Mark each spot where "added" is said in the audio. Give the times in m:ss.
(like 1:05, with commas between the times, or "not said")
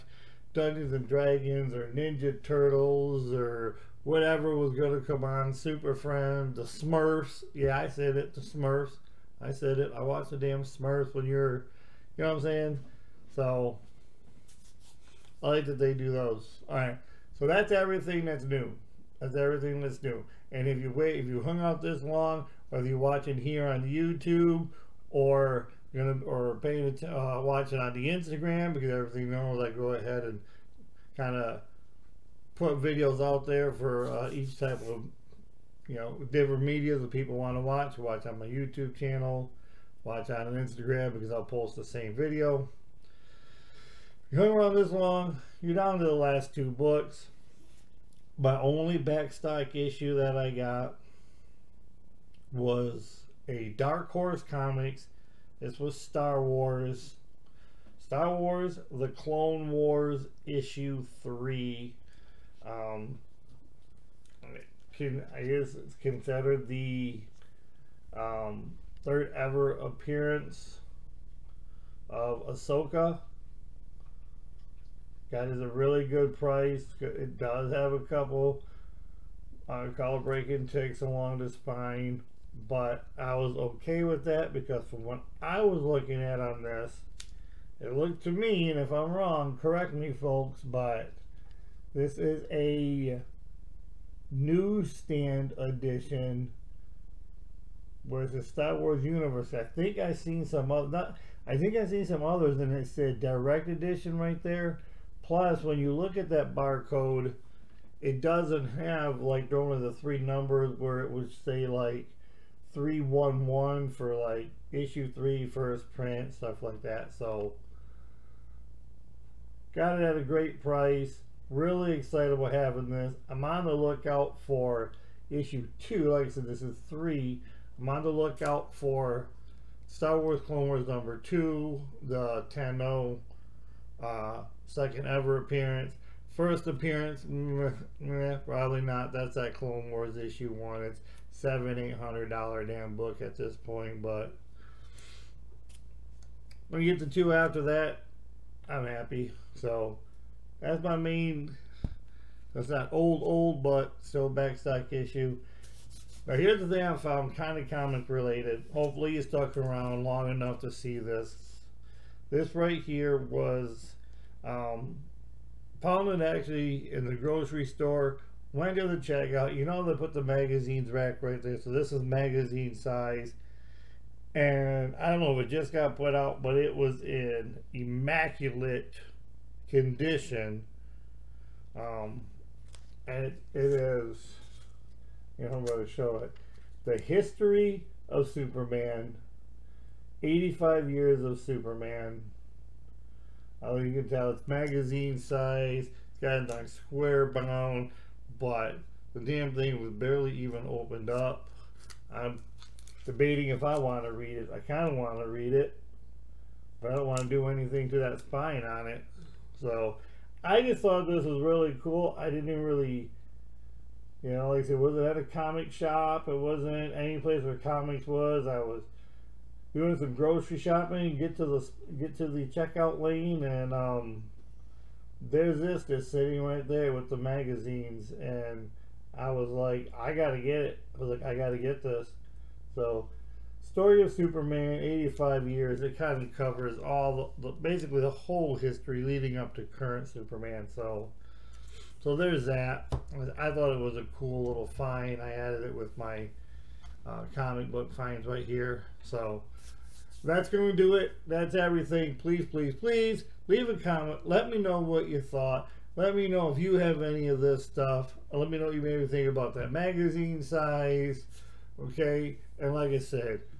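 4:05.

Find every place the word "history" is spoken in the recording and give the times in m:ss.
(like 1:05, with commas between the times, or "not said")
3:06, 3:58.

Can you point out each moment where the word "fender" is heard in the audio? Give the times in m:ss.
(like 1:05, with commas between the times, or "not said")
not said.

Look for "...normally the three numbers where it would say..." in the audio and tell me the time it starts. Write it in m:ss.
1:49.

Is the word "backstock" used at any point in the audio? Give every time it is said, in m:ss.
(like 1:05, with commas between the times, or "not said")
0:48, 2:34.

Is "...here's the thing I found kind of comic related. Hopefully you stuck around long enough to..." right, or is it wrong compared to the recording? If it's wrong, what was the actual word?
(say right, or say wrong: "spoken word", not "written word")
right.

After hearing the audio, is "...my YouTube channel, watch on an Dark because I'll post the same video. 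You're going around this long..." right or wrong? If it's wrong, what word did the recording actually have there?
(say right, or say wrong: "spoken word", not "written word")
wrong: "Instagram", not "Dark".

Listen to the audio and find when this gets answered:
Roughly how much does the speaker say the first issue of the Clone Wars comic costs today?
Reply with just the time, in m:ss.
2:21.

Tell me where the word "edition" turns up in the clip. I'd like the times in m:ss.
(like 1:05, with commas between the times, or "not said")
1:35, 1:43.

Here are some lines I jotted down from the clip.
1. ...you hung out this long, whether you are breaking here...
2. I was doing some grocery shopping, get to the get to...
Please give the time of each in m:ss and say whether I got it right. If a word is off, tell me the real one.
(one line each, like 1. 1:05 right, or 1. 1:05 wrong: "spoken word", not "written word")
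1. 0:21 wrong: "watching", not "breaking"
2. 3:38 right.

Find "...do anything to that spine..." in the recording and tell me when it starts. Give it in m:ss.
3:27.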